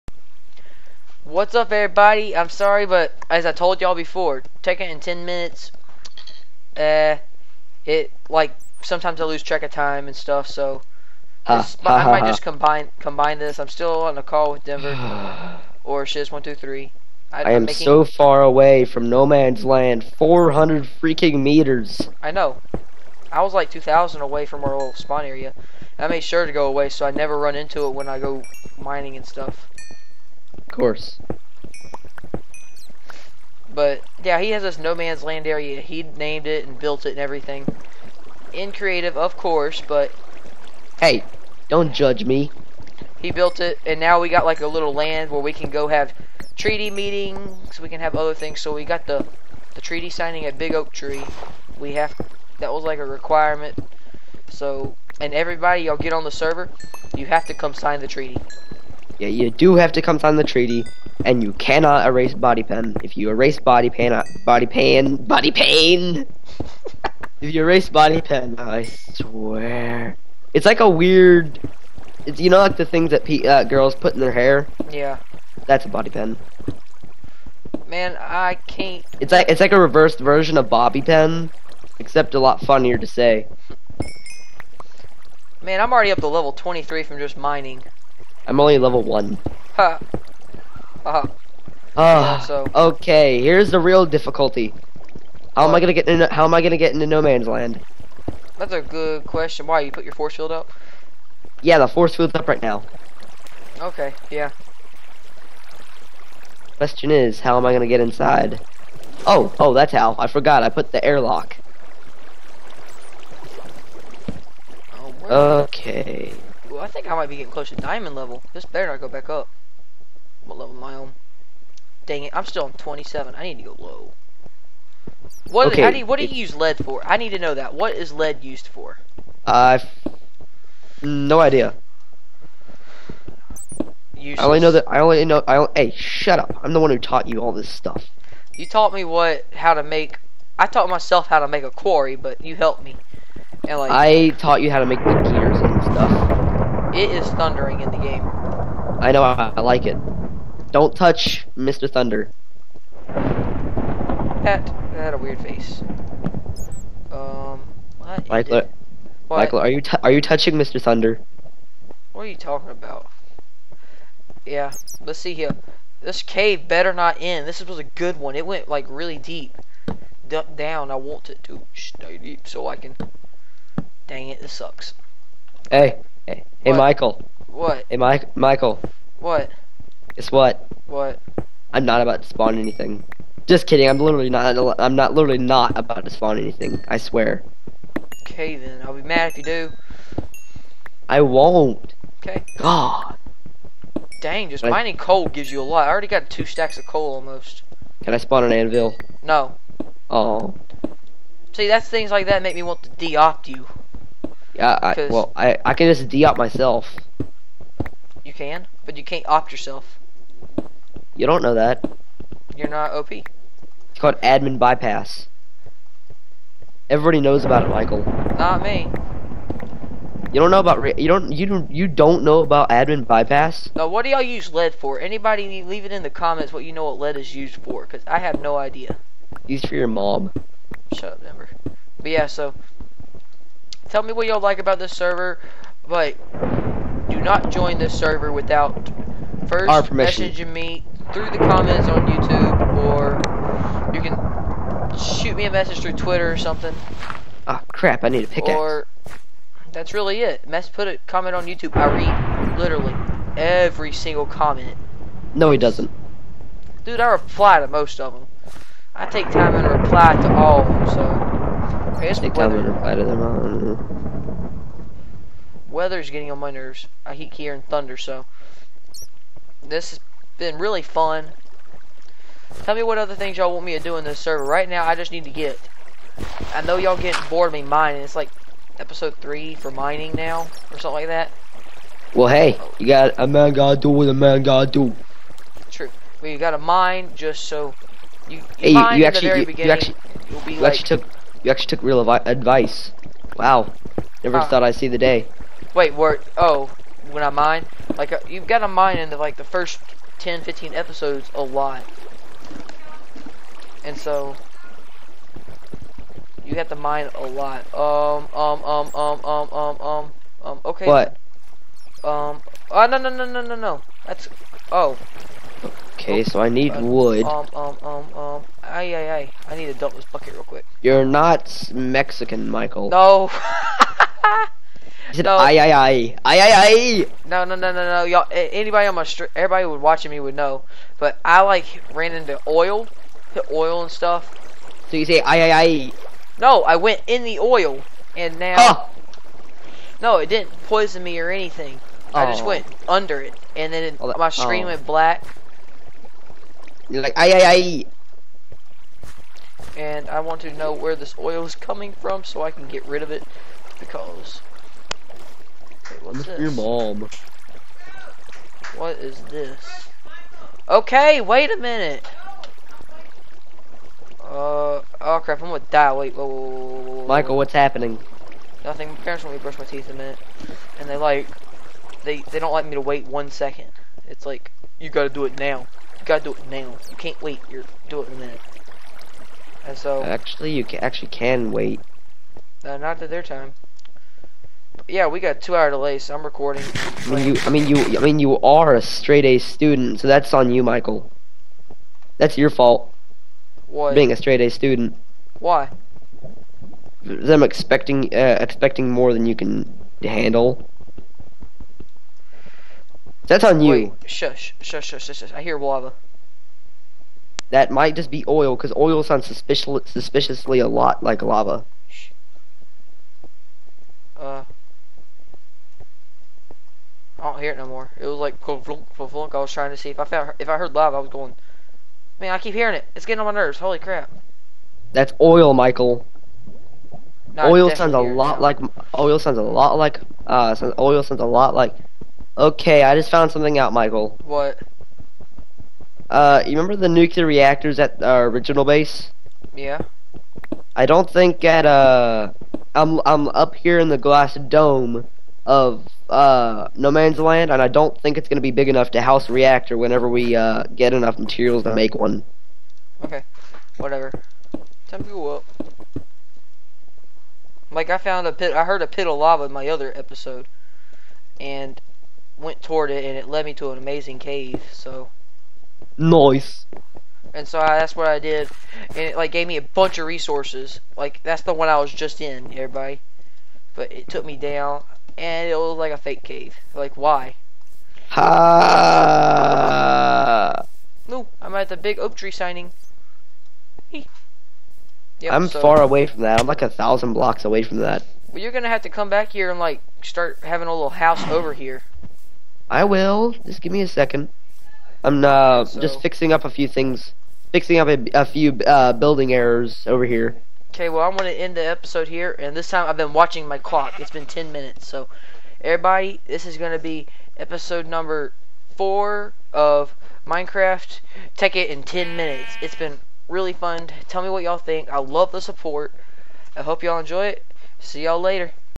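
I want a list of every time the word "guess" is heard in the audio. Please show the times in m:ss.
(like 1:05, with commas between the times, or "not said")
3:00, 4:22.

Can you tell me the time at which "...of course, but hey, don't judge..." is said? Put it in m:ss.
0:39.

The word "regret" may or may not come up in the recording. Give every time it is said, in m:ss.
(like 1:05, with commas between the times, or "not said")
not said.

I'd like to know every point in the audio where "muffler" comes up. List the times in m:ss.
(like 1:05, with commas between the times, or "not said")
not said.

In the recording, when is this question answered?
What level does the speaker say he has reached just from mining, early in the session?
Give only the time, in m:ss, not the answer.
1:26.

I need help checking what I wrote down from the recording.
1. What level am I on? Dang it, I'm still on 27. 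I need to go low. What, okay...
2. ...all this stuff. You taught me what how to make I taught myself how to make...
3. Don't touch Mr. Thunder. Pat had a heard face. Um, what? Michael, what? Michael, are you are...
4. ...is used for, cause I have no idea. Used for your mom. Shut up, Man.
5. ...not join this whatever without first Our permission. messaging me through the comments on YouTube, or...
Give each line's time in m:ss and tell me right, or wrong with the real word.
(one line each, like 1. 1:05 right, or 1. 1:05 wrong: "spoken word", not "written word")
1. 2:00 right
2. 2:17 right
3. 2:30 wrong: "weird", not "heard"
4. 3:47 wrong: "Denver", not "Man"
5. 3:57 wrong: "server", not "whatever".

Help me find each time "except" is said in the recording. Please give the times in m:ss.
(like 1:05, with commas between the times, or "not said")
1:21.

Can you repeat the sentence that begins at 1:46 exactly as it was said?
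Question is, how am I gonna get inside?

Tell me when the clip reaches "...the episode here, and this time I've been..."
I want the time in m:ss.
8:21.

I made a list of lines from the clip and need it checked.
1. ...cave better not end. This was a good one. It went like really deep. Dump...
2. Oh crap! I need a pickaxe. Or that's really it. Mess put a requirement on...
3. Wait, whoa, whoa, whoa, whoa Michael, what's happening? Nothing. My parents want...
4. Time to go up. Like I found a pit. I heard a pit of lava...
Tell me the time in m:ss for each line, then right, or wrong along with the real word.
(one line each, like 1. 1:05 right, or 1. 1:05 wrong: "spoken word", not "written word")
1. 2:46 right
2. 4:07 wrong: "comment", not "requirement"
3. 6:05 right
4. 7:34 right.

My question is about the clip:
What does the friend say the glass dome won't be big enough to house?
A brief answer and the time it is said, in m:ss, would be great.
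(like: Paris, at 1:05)
a reactor, at 7:29.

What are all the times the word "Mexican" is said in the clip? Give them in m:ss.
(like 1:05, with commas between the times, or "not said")
5:21.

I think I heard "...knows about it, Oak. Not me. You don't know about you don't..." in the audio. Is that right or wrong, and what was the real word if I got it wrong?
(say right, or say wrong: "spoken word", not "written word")
wrong: "Michael", not "Oak".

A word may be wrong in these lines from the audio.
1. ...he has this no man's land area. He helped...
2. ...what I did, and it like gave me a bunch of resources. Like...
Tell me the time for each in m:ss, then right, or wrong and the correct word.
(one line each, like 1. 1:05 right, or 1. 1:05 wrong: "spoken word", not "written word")
1. 0:34 wrong: "named", not "helped"
2. 7:47 right.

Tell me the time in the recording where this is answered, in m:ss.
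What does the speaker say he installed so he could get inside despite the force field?
1:51.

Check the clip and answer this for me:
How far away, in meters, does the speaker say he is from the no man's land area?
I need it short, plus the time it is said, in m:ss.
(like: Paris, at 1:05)
400, at 0:20.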